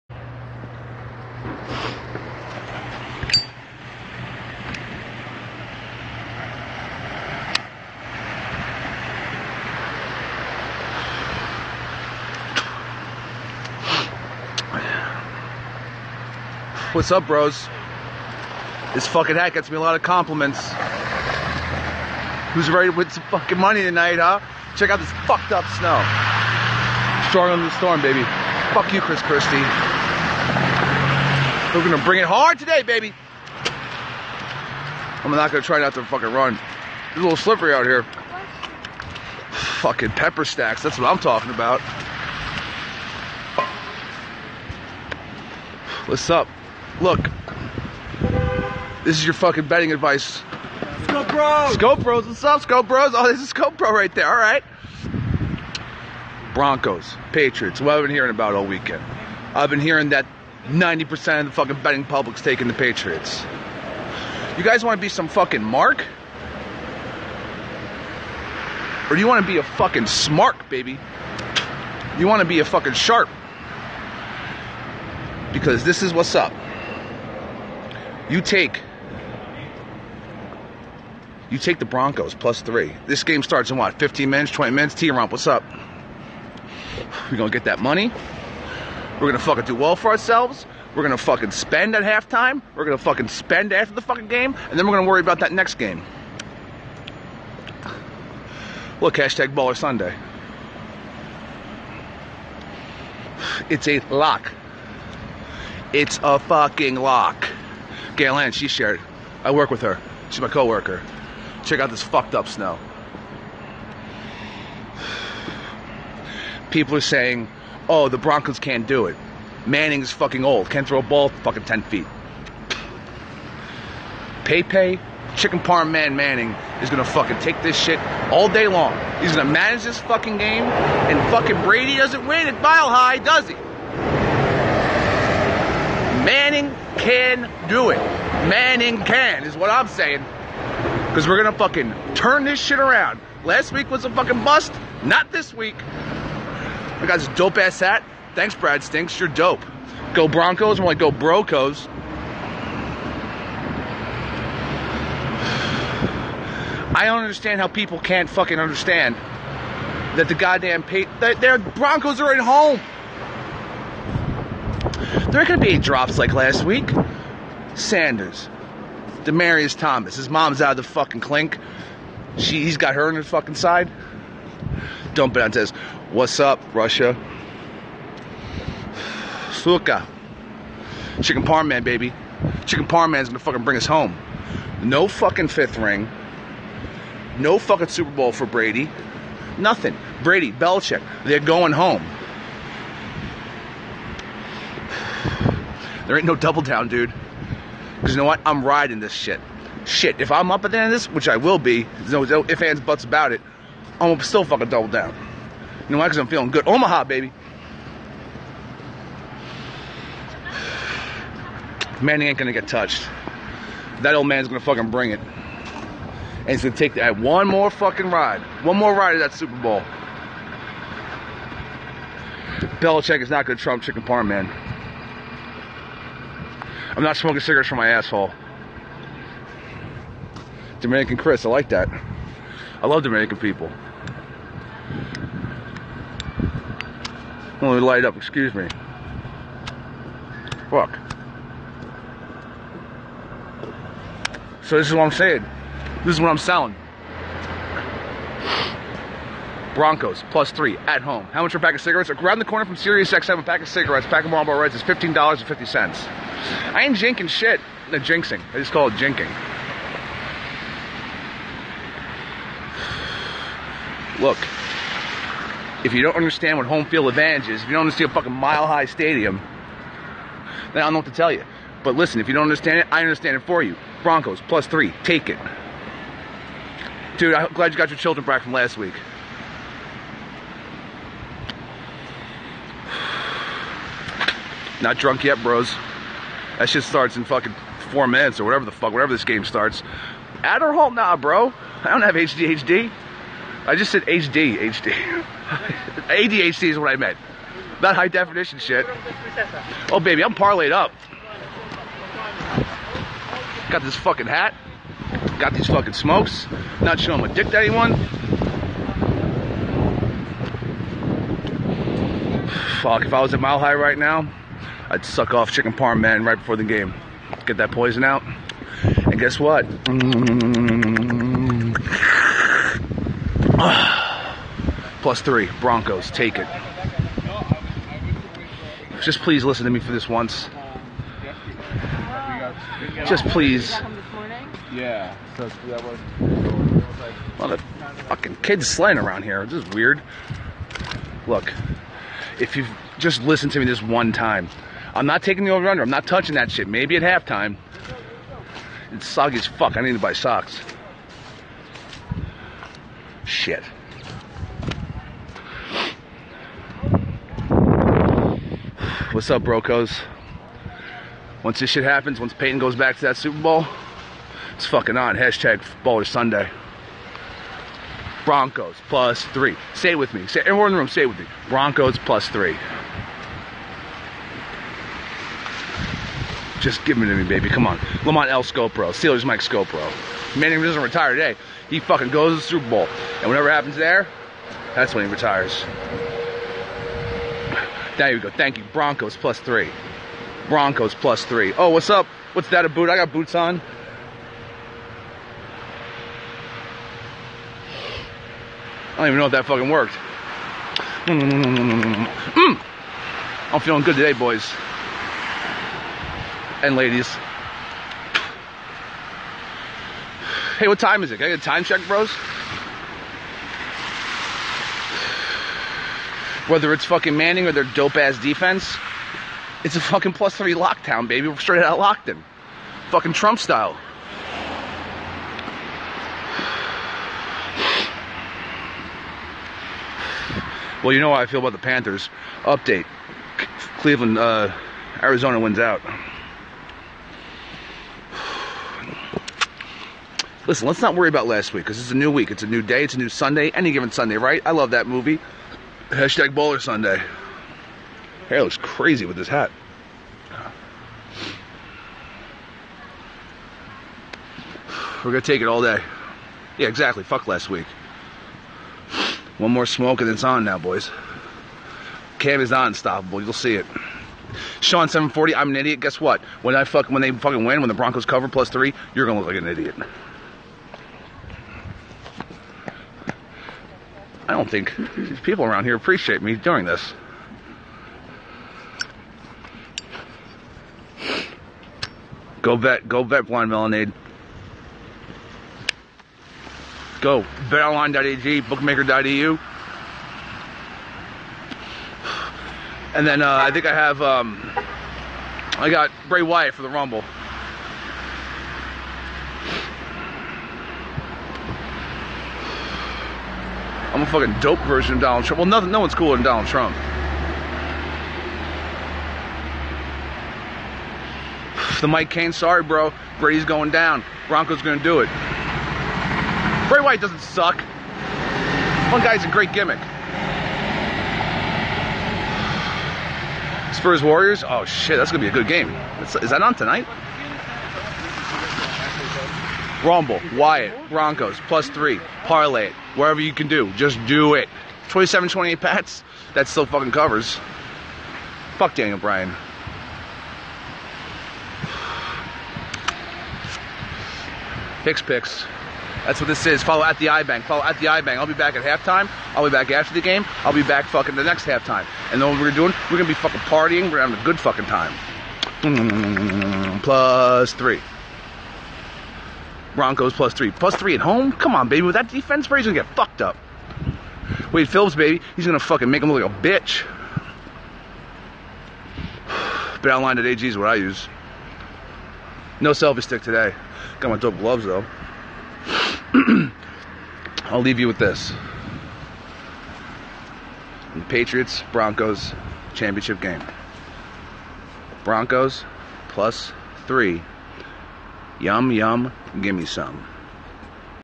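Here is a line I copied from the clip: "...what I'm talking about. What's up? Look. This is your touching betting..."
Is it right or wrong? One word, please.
wrong.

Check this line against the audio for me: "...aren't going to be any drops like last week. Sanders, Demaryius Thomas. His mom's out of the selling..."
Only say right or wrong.
wrong.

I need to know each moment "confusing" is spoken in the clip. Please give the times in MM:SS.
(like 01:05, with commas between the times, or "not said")
not said.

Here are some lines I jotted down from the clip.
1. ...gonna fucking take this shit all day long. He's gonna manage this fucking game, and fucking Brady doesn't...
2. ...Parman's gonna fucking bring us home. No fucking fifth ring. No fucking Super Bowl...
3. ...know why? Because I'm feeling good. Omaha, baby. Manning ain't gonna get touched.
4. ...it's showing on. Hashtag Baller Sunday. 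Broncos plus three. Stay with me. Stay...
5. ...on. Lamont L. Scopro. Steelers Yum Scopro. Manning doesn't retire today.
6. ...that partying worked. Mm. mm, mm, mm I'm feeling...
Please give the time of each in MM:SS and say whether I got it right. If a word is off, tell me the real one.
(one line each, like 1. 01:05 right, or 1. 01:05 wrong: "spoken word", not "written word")
1. 02:06 right
2. 03:02 right
3. 03:25 right
4. 06:04 wrong: "fucking", not "showing"
5. 06:17 wrong: "Mike", not "Yum"
6. 06:39 wrong: "fucking", not "partying".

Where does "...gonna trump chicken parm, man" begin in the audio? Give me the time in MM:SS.
03:43.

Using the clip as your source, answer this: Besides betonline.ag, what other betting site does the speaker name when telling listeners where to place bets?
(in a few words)
bookmaker.eu.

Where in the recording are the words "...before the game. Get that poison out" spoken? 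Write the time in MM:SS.
05:16.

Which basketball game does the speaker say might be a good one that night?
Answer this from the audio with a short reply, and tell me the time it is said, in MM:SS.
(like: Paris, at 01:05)
Spurs Warriors, at 08:43.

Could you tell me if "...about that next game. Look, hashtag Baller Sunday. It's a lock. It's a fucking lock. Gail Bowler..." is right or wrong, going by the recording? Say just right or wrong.
wrong.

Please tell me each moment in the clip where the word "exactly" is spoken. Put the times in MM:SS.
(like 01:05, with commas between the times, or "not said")
07:36.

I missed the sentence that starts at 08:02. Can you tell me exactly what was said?
Go bet, go bet blind melonade.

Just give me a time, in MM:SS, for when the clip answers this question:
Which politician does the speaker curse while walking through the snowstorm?
00:28.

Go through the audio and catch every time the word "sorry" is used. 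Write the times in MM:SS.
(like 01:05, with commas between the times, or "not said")
08:32.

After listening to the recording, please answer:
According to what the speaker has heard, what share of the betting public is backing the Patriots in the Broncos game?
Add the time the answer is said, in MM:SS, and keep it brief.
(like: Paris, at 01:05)
90%, at 01:00.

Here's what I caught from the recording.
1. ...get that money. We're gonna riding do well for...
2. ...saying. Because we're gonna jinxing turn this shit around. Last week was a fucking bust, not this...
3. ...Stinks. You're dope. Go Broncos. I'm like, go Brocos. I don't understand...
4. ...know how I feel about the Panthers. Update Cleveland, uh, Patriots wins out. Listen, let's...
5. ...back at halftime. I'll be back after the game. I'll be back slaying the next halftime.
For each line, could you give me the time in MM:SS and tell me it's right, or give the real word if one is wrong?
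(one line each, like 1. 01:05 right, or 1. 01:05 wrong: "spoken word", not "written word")
1. 01:27 wrong: "fucking", not "riding"
2. 02:19 wrong: "fucking", not "jinxing"
3. 02:28 right
4. 07:10 wrong: "Arizona", not "Patriots"
5. 09:08 wrong: "fucking", not "slaying".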